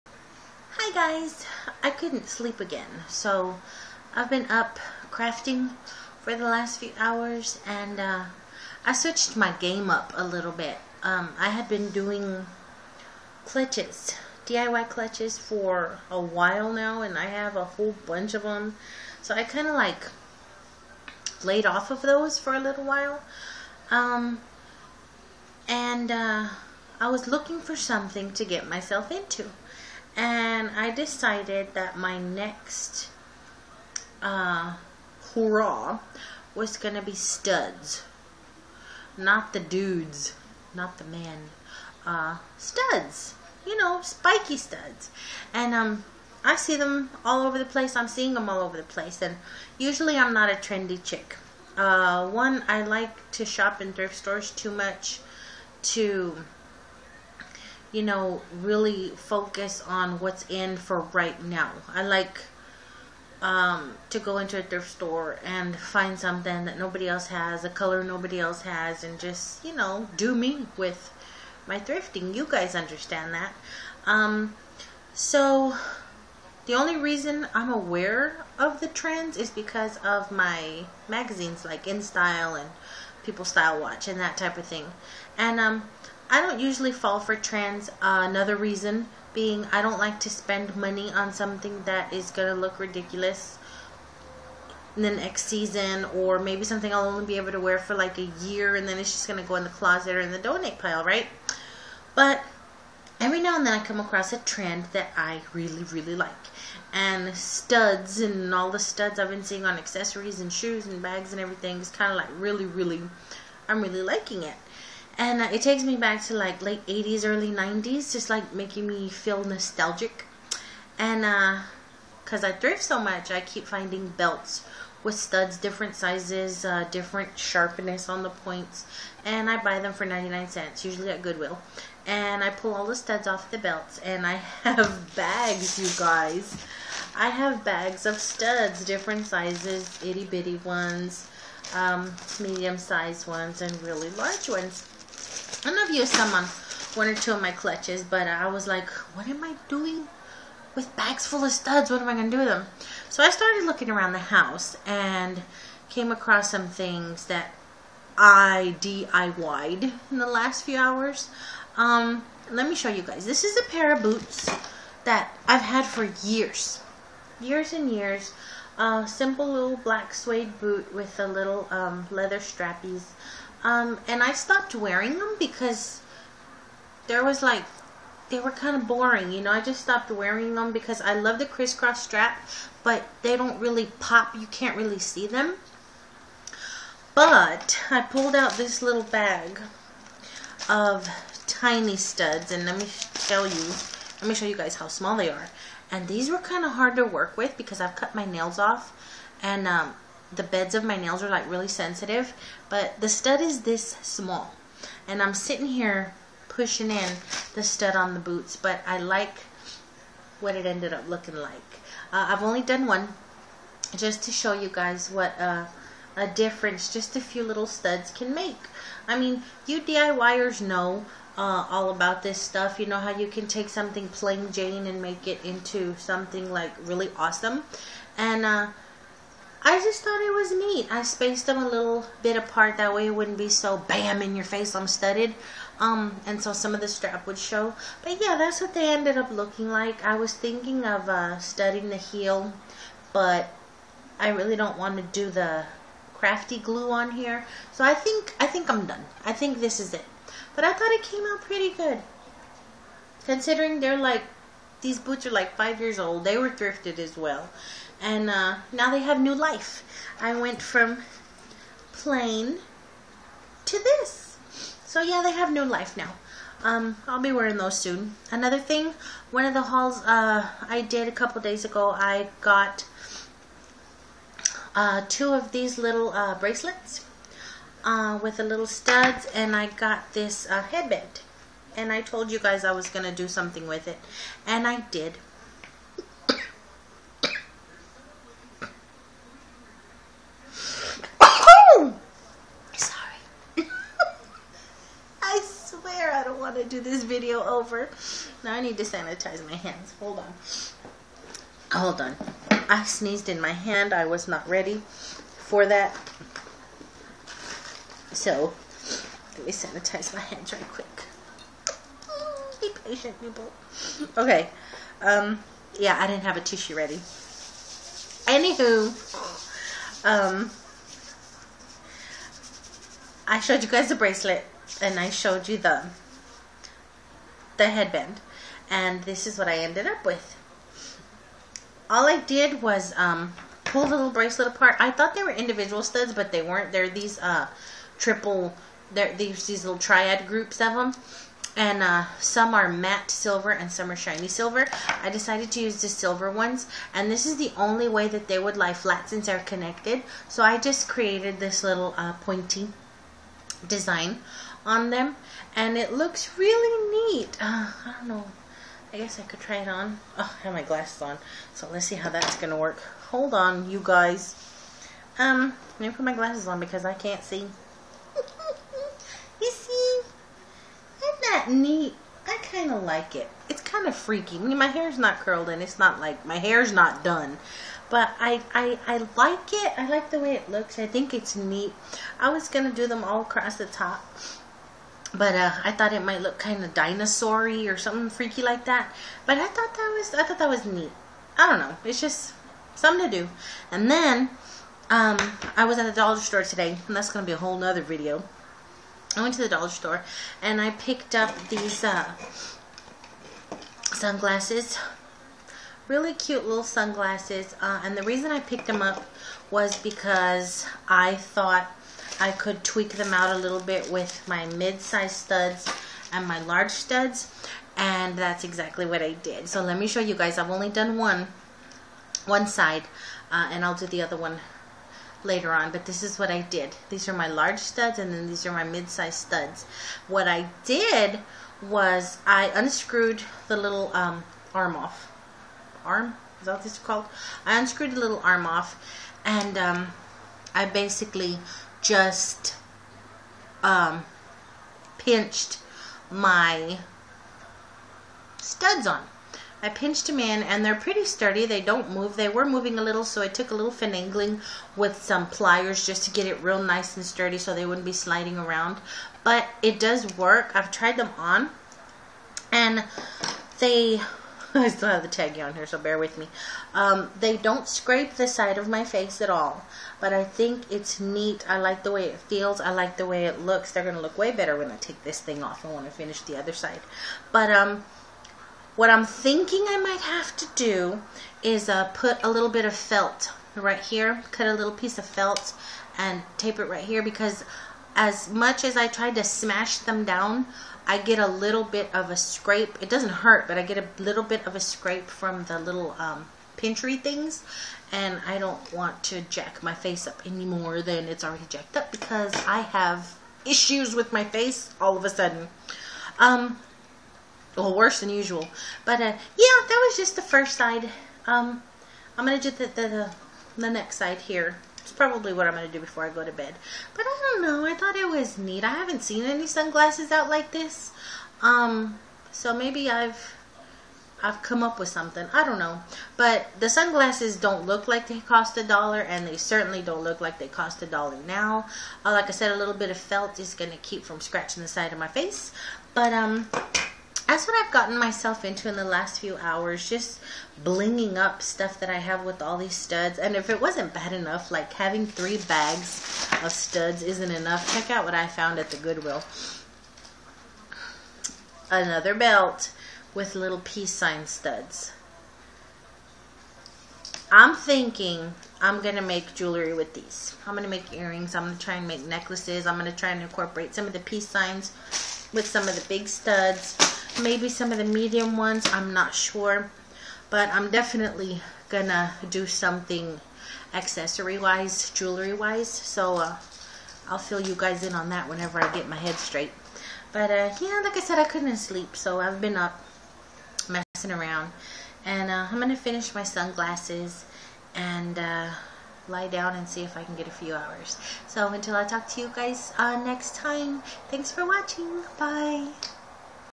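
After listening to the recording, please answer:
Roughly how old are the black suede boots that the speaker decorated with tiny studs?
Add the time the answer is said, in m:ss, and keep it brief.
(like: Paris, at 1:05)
5 years, at 4:15.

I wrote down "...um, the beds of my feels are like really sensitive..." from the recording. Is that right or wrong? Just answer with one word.
wrong.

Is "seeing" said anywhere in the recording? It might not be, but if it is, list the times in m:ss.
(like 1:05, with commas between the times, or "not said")
0:48, 1:49.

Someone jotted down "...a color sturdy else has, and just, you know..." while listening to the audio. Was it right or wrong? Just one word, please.
wrong.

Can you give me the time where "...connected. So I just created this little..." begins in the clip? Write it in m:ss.
5:49.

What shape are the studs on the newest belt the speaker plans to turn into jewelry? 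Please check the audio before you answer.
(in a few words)
peace signs.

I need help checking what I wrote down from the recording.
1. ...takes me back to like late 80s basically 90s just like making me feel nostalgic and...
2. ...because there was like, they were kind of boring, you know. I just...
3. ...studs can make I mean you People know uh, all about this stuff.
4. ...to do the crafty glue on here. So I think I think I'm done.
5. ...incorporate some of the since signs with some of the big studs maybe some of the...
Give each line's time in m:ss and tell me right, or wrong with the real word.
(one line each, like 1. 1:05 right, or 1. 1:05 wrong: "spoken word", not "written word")
1. 1:55 wrong: "early", not "basically"
2. 2:55 right
3. 3:37 wrong: "DIYers", not "People"
4. 4:04 right
5. 9:23 wrong: "peace", not "since".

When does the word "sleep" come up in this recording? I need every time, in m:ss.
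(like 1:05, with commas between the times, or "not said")
0:02, 9:41.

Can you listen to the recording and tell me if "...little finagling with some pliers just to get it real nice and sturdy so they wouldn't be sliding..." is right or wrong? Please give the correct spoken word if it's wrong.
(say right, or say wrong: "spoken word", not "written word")
right.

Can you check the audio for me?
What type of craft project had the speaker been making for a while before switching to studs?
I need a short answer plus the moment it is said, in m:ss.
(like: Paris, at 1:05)
DIY clutches, at 0:14.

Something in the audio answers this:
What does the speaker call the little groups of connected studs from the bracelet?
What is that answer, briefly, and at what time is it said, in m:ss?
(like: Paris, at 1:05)
triad groups, at 5:39.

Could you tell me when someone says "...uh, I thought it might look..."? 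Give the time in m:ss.
6:25.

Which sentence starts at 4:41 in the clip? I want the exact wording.
And I told you guys I was going to do something with it, and I did.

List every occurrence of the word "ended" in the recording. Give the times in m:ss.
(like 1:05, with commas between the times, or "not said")
3:30, 3:58, 5:29.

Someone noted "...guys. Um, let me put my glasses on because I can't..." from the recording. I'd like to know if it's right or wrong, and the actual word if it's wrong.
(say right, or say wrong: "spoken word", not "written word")
right.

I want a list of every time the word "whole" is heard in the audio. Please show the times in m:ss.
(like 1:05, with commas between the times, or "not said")
0:17, 6:37.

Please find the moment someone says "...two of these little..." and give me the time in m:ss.
4:35.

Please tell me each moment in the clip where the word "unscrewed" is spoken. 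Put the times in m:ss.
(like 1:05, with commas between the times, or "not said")
7:12, 7:17.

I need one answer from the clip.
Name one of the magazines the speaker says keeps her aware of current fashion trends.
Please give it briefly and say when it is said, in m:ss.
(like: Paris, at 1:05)
InStyle, at 1:21.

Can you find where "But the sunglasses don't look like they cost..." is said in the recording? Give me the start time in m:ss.
8:46.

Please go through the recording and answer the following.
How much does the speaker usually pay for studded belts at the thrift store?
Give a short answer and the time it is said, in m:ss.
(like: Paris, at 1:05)
99 cents, at 2:10.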